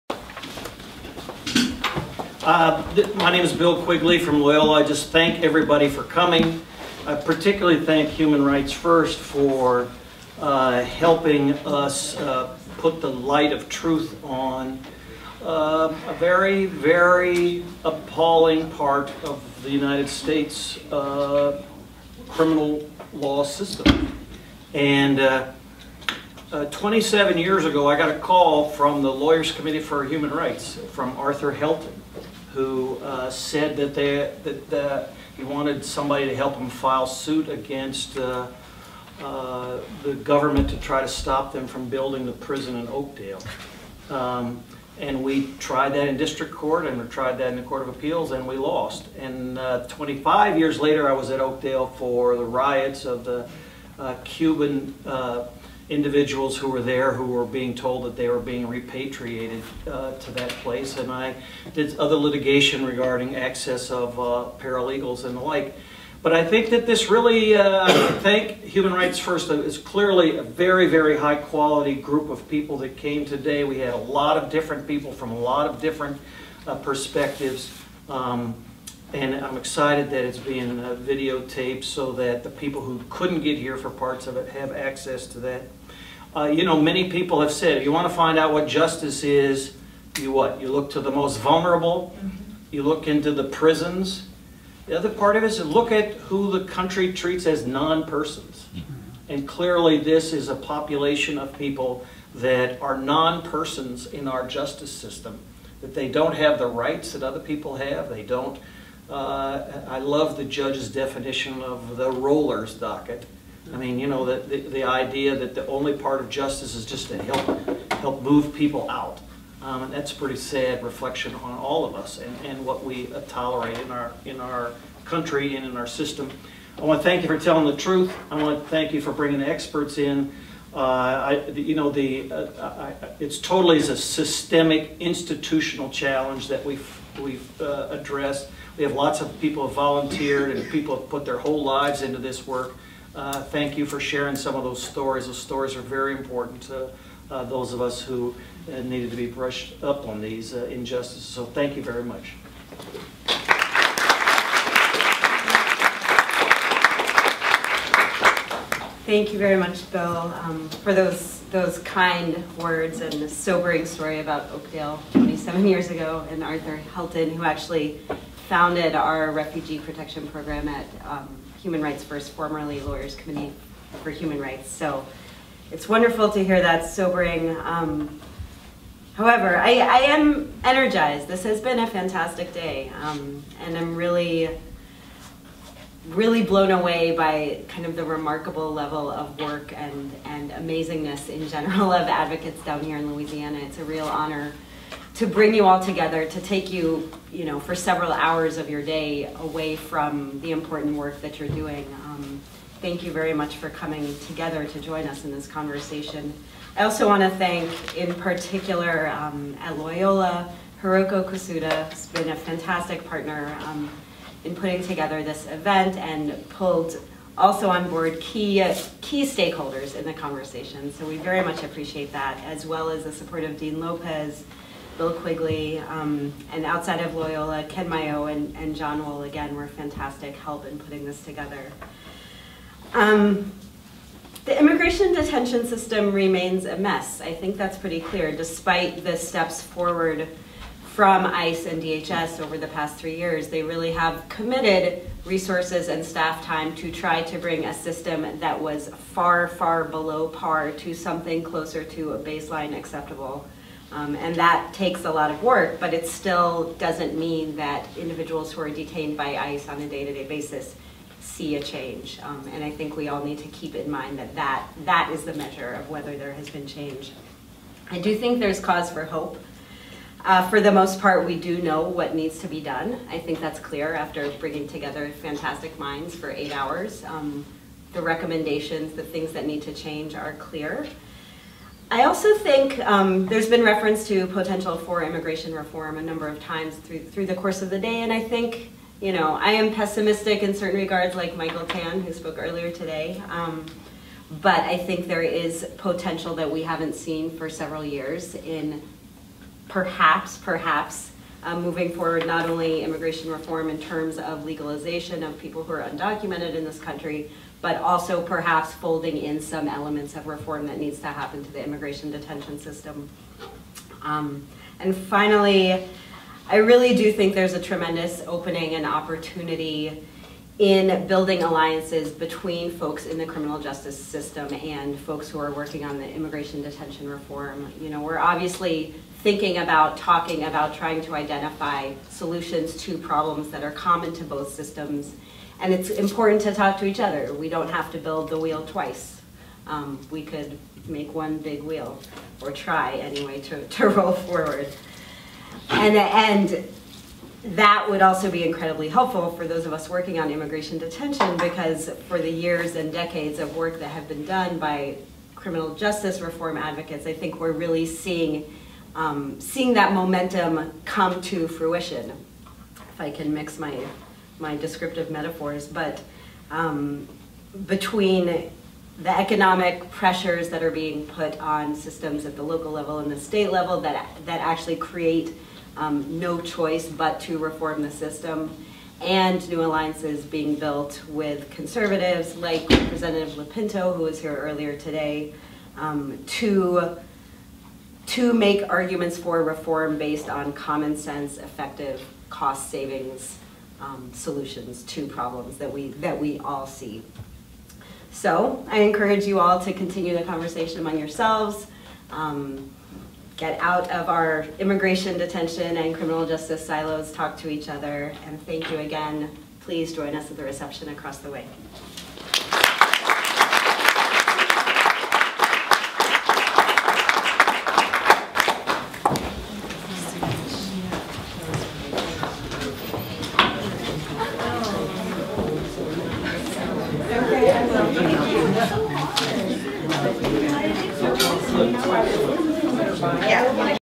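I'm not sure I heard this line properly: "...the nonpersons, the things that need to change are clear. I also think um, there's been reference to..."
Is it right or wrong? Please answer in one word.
wrong.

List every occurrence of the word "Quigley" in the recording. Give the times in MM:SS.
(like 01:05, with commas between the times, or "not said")
00:03, 03:45.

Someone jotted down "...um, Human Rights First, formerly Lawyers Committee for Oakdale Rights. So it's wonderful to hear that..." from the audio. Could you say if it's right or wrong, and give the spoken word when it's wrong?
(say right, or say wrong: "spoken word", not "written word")
wrong: "Human", not "Oakdale".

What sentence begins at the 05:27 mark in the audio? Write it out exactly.
You know, we're obviously thinking about, talking about, trying to identify solutions to problems that are common to both systems.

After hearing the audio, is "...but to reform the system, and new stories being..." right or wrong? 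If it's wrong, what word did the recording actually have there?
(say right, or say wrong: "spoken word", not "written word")
wrong: "alliances", not "stories".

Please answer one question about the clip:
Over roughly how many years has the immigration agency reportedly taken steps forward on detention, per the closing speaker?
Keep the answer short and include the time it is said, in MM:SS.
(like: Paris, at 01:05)
3, at 04:02.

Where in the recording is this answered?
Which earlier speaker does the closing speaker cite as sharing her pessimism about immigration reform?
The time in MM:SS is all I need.
04:51.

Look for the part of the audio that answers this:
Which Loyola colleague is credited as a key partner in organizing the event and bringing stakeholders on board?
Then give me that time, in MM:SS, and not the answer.
03:30.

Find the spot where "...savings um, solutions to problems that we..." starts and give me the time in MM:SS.
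06:32.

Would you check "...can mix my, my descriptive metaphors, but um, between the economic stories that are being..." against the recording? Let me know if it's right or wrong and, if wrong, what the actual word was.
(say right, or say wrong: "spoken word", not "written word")
wrong: "pressures", not "stories".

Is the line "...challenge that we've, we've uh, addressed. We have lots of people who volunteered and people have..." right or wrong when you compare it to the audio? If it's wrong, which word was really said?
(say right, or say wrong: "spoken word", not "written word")
right.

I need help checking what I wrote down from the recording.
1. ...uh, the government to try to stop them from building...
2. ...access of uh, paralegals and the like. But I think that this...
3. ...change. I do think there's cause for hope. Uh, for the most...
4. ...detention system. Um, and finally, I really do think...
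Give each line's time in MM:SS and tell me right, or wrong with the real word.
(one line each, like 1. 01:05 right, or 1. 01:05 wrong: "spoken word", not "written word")
1. 00:39 right
2. 01:03 right
3. 04:26 right
4. 05:12 right.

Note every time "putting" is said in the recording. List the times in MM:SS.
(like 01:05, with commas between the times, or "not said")
03:34, 03:50.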